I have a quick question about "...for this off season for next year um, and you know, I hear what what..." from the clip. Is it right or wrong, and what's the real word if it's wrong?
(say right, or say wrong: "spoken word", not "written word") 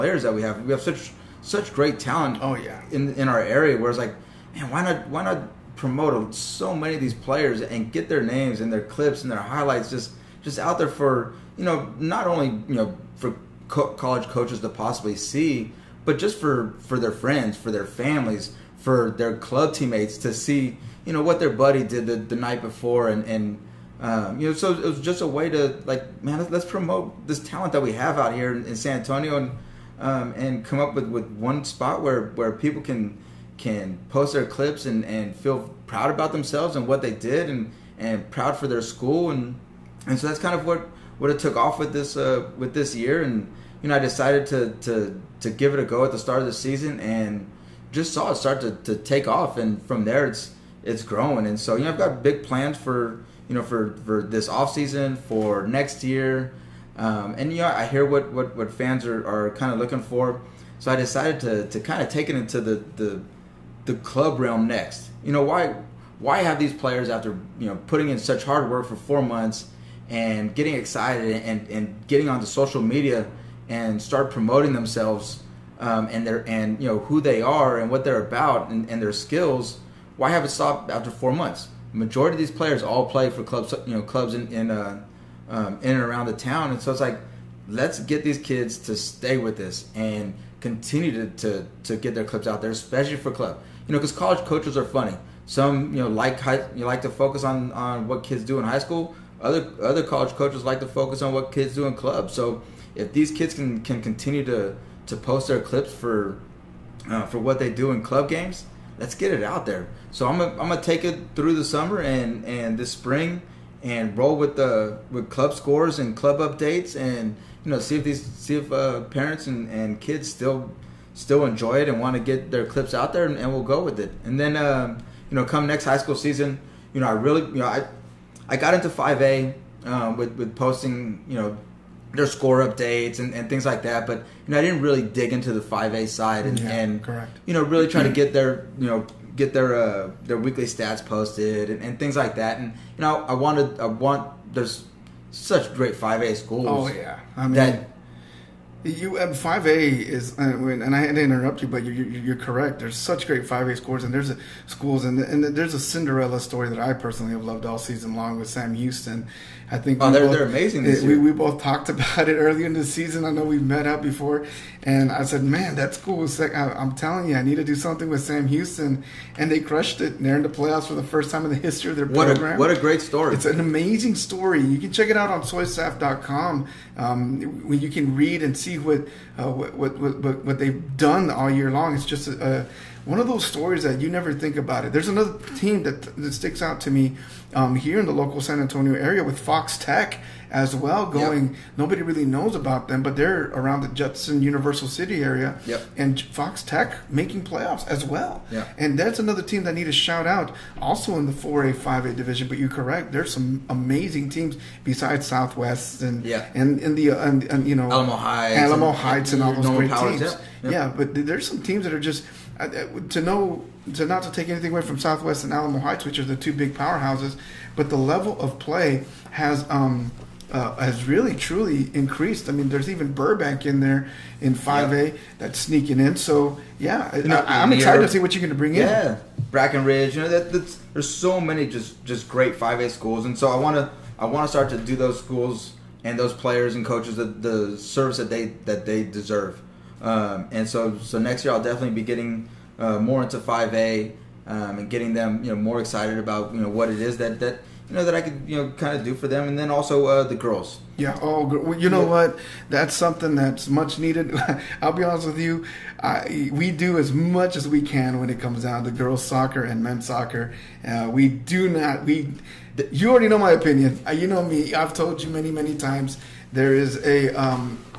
right.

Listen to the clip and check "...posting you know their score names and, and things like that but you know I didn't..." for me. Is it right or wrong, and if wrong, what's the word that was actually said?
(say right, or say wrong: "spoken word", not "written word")
wrong: "updates", not "names".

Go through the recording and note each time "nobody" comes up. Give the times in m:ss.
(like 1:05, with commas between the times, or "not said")
3:11.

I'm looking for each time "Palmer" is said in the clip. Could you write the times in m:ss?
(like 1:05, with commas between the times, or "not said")
not said.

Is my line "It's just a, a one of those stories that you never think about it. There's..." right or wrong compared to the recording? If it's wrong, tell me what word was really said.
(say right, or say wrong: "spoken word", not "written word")
right.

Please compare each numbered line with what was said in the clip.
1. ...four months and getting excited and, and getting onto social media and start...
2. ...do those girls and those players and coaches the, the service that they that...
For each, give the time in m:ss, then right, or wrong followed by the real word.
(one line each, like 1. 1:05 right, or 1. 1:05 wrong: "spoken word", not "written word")
1. 1:08 right
2. 3:54 wrong: "schools", not "girls".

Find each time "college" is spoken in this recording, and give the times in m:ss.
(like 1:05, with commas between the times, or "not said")
0:13, 1:34, 1:40.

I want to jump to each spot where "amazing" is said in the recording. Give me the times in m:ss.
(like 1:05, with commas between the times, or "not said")
2:40, 2:53, 3:23.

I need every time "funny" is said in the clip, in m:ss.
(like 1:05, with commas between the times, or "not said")
1:34.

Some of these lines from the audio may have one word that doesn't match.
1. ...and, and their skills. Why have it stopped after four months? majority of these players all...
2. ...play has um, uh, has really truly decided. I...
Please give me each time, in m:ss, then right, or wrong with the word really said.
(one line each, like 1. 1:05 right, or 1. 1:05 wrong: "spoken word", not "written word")
1. 1:18 right
2. 3:38 wrong: "increased", not "decided".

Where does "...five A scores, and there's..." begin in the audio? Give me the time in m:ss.
2:33.